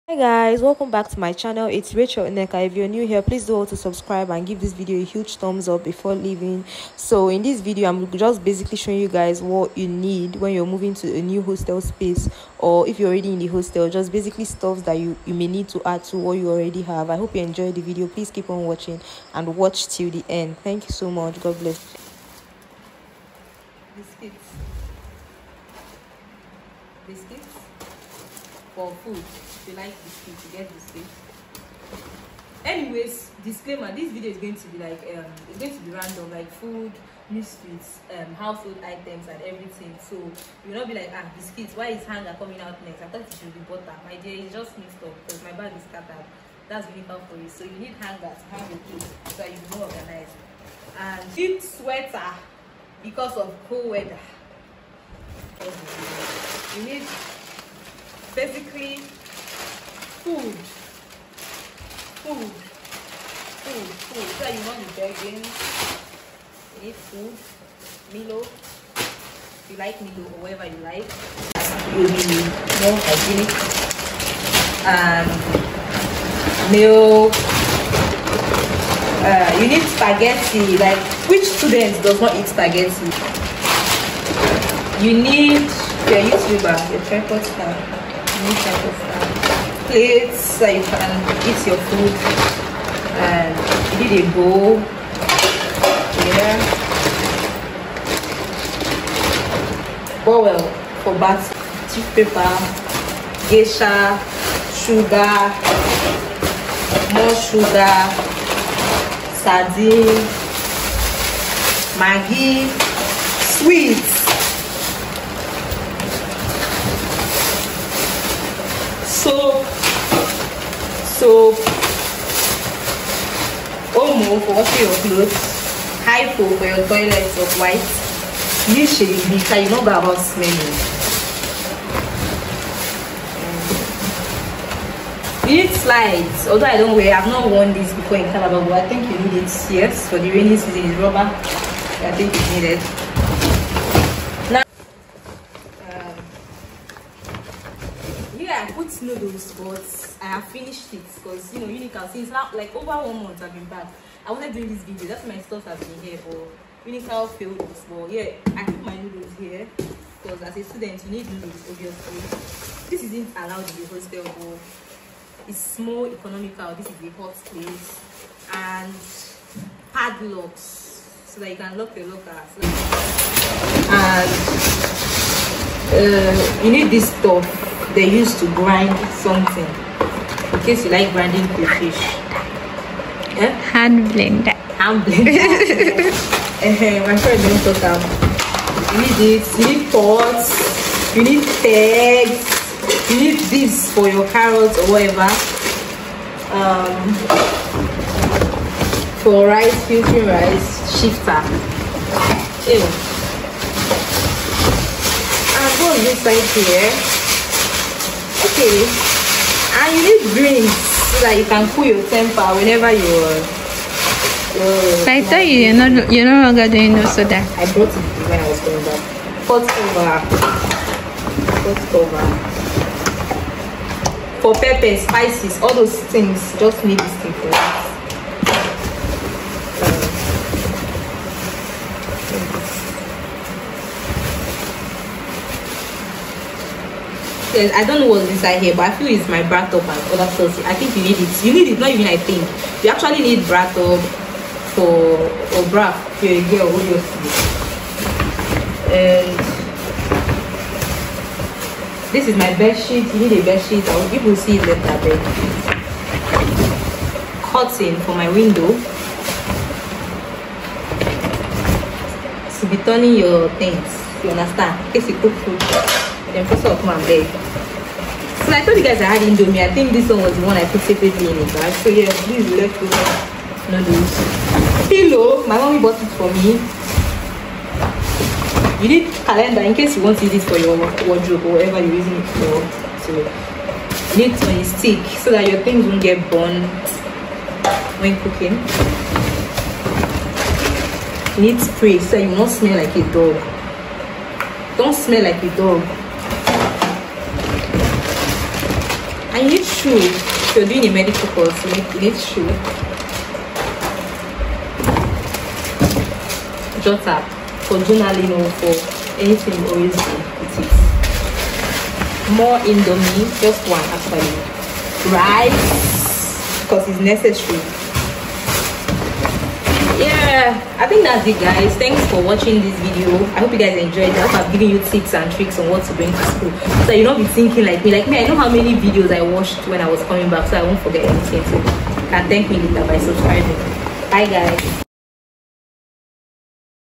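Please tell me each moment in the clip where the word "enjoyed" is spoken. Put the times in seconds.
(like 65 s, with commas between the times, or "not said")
17 s, 323 s.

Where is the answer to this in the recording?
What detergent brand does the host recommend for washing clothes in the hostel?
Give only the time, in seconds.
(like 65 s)
123 s.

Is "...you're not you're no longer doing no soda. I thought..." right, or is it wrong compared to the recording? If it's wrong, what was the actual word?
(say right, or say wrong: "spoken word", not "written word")
wrong: "brought", not "thought".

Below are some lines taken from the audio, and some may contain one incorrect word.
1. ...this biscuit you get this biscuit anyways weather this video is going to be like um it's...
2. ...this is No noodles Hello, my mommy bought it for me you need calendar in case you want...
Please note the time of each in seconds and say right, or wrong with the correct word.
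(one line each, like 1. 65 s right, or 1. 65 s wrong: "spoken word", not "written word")
1. 30 s wrong: "disclaimer", not "weather"
2. 272 s right.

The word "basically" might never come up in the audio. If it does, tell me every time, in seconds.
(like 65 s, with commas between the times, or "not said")
8 s, 14 s, 58 s.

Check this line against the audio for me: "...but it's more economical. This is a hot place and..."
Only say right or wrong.
right.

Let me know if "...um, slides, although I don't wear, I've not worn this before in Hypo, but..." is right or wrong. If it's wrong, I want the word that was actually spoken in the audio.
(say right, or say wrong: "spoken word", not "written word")
wrong: "Calabar", not "Hypo".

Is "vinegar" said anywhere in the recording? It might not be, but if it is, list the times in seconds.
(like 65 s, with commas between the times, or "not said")
46 s.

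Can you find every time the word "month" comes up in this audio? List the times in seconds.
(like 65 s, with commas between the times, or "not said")
153 s.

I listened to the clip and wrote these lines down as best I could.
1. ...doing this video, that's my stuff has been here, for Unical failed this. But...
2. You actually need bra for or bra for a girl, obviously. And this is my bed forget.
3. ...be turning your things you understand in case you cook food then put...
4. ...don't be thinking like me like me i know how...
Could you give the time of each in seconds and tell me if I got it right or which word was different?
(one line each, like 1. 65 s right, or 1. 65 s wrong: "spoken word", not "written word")
1. 154 s right
2. 242 s wrong: "sheet", not "forget"
3. 262 s right
4. 327 s right.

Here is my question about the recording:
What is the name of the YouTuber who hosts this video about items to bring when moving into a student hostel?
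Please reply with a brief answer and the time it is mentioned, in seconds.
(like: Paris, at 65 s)
Rachel Nneka, at 1 s.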